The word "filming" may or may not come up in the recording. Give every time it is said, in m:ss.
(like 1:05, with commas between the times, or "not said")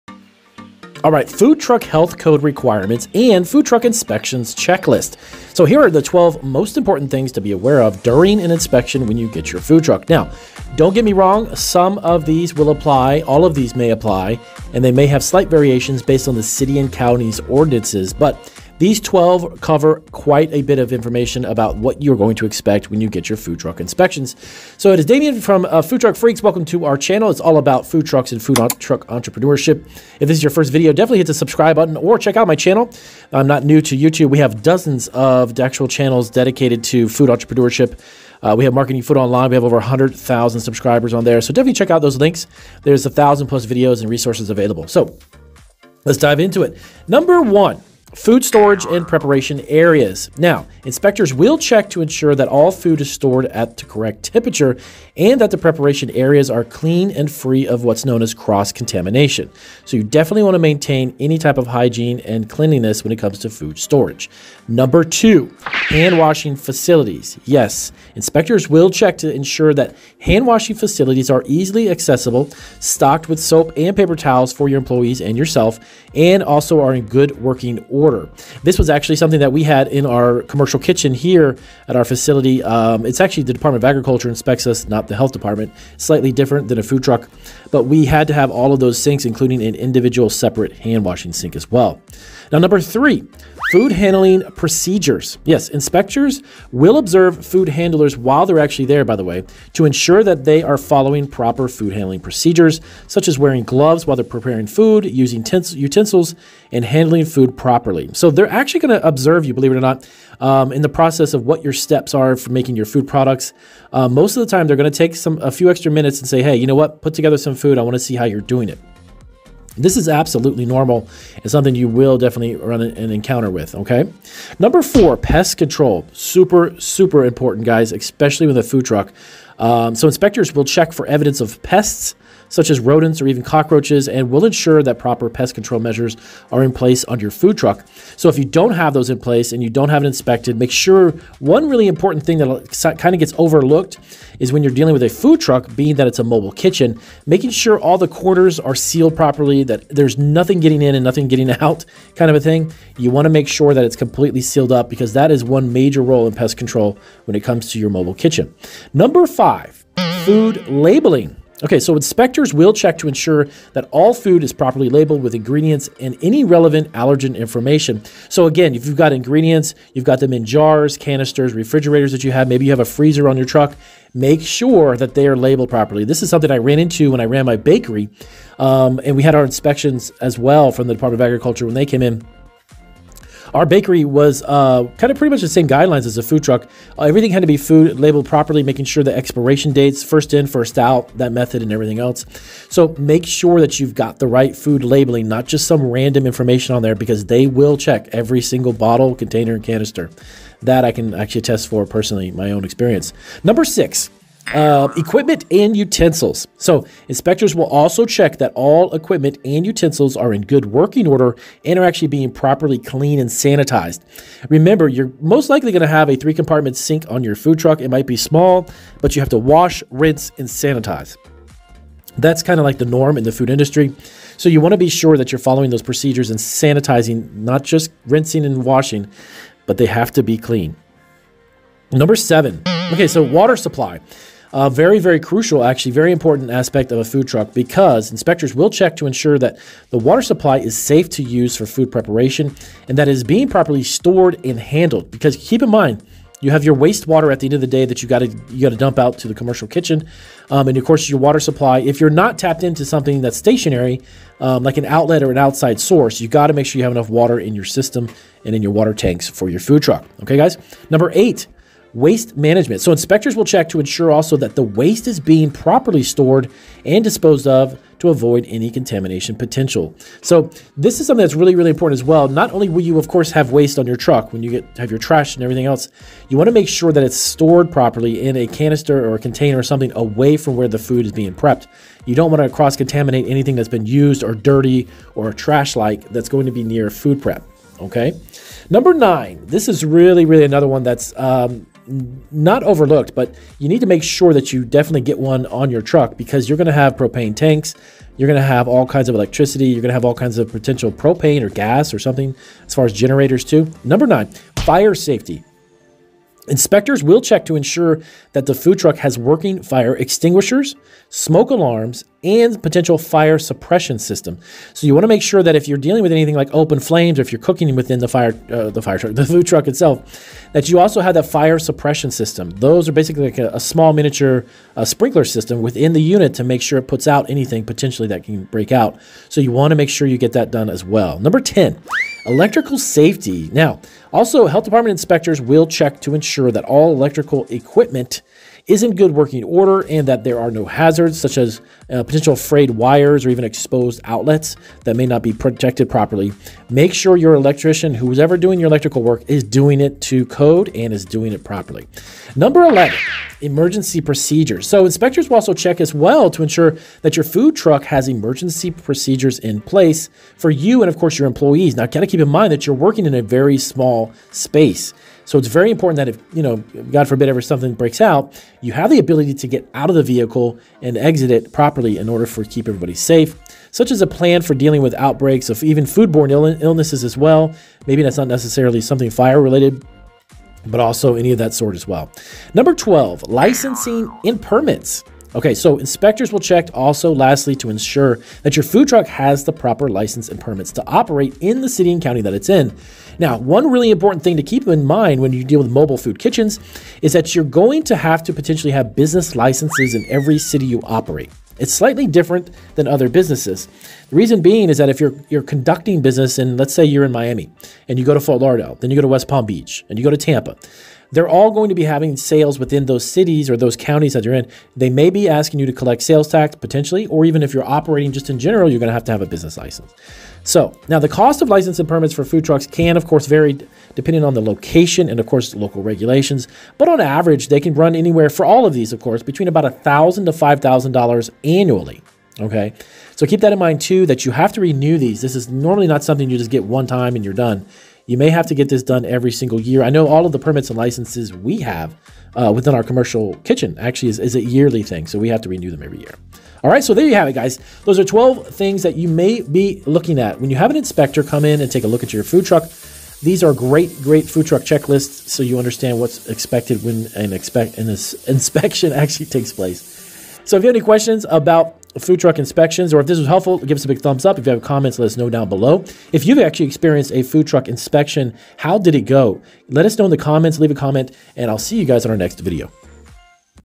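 not said.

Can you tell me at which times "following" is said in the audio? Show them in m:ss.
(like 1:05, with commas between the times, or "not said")
1:40, 3:45.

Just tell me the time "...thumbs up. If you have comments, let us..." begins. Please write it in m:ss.
7:43.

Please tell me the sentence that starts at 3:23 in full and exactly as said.
Number six, uh, equipment and utensils.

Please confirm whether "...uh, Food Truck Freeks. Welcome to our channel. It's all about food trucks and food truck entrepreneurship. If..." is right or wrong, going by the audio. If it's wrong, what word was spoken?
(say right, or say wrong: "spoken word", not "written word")
right.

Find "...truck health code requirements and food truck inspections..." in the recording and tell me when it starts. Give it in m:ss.
0:01.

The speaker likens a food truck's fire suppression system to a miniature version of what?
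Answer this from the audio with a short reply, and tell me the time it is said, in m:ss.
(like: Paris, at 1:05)
Sprinkler system, at 5:24.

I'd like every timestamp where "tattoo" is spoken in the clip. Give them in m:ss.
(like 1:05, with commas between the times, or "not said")
not said.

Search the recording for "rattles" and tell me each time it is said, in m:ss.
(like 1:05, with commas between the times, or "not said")
not said.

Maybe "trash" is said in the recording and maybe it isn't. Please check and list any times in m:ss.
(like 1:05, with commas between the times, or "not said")
4:34, 4:45.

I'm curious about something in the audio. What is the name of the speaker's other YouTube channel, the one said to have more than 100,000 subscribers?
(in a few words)
Marketing Food Online.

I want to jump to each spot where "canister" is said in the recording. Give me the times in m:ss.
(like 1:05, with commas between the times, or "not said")
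2:50, 3:19, 4:38.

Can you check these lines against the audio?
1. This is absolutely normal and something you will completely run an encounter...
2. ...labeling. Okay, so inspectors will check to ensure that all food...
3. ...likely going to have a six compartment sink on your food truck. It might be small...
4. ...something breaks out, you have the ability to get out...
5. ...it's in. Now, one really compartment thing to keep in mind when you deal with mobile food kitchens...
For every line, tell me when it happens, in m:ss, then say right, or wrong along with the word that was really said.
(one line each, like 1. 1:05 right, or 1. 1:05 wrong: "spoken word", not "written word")
1. 1:59 wrong: "definitely", not "completely"
2. 2:40 right
3. 3:35 wrong: "three", not "six"
4. 6:07 right
5. 6:32 wrong: "important", not "compartment".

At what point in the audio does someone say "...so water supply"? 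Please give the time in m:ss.
3:53.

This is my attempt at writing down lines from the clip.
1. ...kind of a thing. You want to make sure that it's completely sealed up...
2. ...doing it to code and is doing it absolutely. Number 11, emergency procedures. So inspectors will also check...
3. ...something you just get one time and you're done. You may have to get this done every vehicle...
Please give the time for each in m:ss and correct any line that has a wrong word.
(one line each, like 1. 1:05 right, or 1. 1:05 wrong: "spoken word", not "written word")
1. 2:32 right
2. 5:49 wrong: "properly", not "absolutely"
3. 7:16 wrong: "single", not "vehicle".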